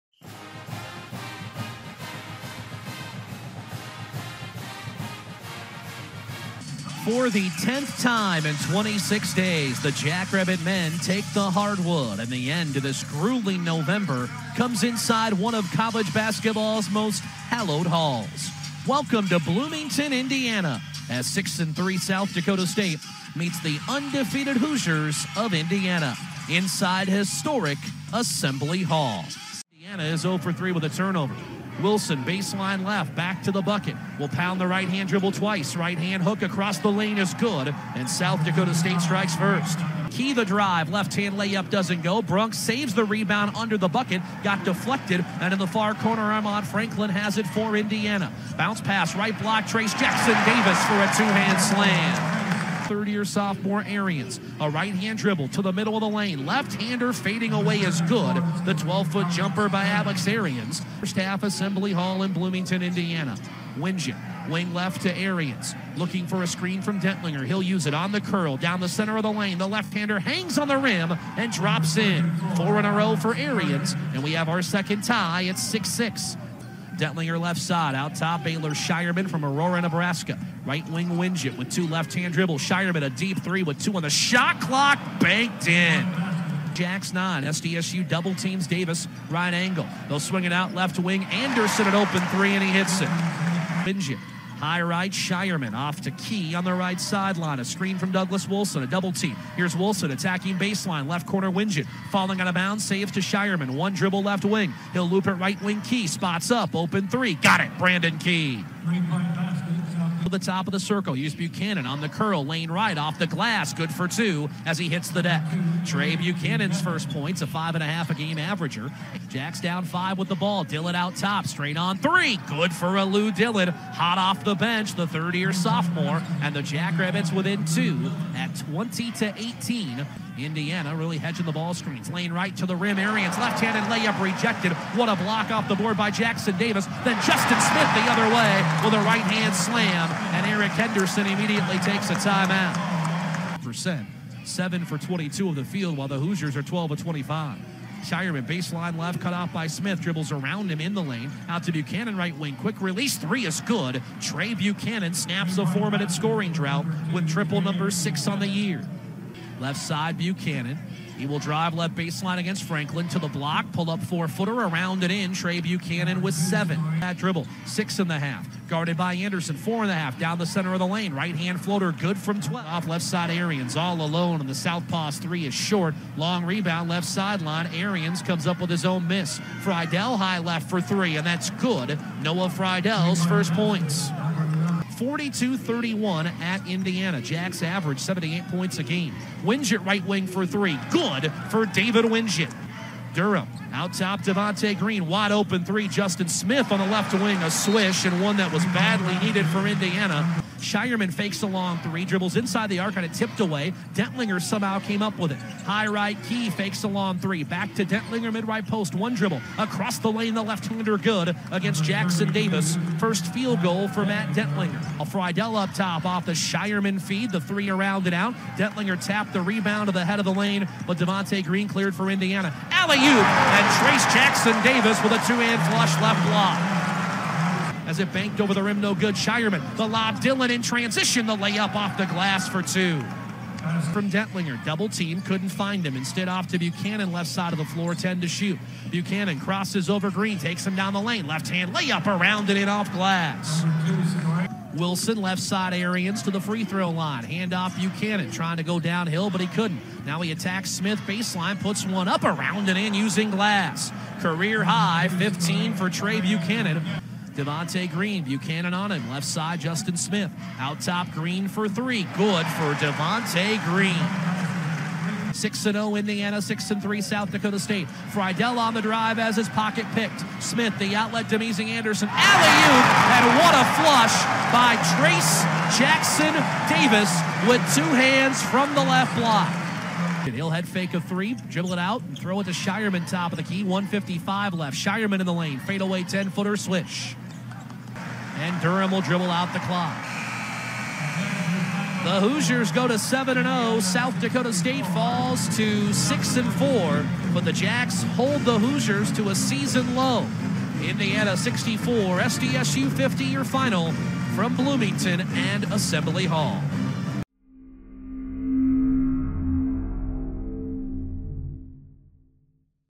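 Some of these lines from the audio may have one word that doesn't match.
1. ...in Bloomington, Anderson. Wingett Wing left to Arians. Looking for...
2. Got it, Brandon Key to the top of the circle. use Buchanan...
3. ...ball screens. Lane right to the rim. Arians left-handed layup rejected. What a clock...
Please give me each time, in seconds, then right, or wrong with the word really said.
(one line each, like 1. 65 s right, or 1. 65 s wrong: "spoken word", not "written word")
1. 62 s wrong: "Indiana", not "Anderson"
2. 107 s right
3. 131 s wrong: "block", not "clock".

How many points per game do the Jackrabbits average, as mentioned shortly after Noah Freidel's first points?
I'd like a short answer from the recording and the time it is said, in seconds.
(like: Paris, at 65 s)
78, at 187 s.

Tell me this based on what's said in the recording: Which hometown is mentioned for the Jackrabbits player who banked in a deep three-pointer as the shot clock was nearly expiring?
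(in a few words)
Aurora, Nebraska.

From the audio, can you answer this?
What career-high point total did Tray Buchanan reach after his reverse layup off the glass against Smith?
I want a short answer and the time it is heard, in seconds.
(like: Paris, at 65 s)
15, at 255 s.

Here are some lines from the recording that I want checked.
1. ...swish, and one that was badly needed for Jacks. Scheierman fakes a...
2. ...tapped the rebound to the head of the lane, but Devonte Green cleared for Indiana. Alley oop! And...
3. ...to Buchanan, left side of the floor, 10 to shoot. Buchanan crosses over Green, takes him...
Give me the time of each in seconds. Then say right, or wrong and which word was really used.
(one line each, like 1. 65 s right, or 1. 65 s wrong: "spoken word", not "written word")
1. 197 s wrong: "Indiana", not "Jacks"
2. 219 s right
3. 236 s right.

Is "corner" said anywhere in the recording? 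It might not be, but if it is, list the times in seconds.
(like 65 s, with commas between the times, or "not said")
45 s, 101 s.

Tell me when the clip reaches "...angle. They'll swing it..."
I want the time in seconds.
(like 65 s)
89 s.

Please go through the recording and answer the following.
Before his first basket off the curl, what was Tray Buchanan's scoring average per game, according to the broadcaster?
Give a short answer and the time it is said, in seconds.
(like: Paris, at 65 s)
5.5, at 117 s.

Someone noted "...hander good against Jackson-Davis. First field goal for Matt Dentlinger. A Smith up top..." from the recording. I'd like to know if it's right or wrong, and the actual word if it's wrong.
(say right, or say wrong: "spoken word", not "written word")
wrong: "Freidel", not "Smith".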